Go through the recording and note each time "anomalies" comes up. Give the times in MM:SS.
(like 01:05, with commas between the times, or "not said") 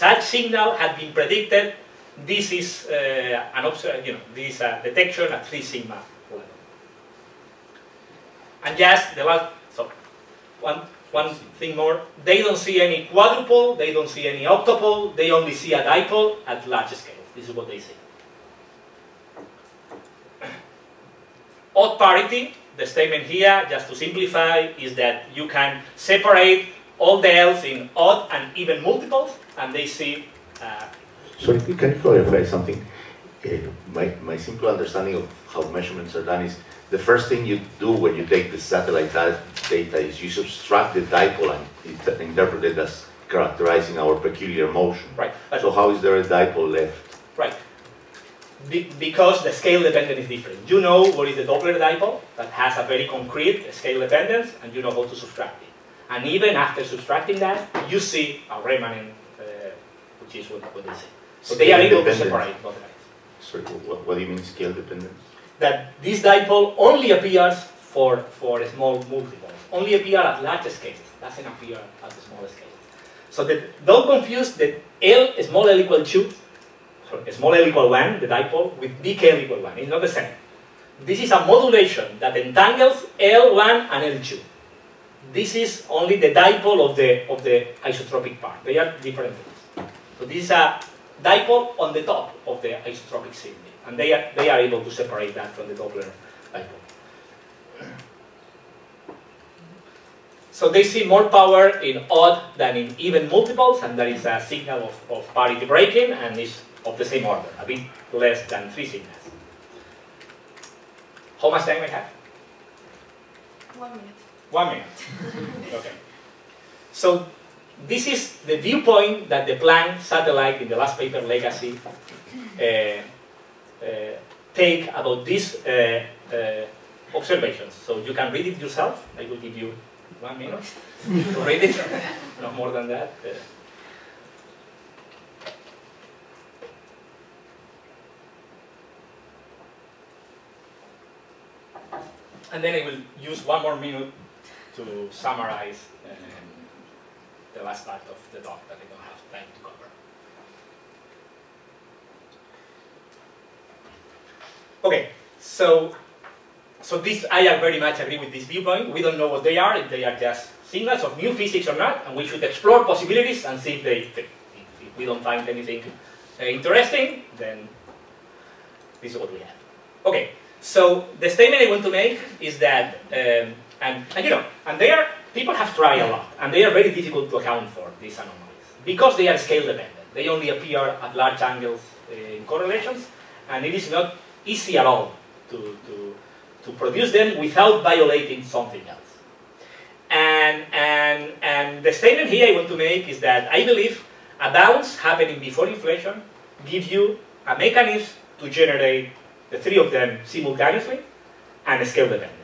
02:58.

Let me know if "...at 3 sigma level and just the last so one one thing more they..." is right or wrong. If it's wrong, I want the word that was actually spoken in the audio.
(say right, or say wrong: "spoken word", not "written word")
right.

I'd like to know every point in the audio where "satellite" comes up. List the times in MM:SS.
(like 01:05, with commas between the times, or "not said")
00:38, 02:00.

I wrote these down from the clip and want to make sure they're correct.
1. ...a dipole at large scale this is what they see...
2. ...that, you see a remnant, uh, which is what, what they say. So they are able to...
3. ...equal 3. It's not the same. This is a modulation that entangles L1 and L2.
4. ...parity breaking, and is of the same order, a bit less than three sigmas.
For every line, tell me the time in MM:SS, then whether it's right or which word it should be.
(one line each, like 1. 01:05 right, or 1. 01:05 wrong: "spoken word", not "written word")
1. 00:15 right
2. 00:57 right
3. 01:19 wrong: "1", not "3"
4. 01:45 right.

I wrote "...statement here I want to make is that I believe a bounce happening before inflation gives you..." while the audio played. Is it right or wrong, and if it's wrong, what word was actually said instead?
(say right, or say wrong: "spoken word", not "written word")
right.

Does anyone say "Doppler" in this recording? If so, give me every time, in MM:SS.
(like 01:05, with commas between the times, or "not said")
00:51, 01:35.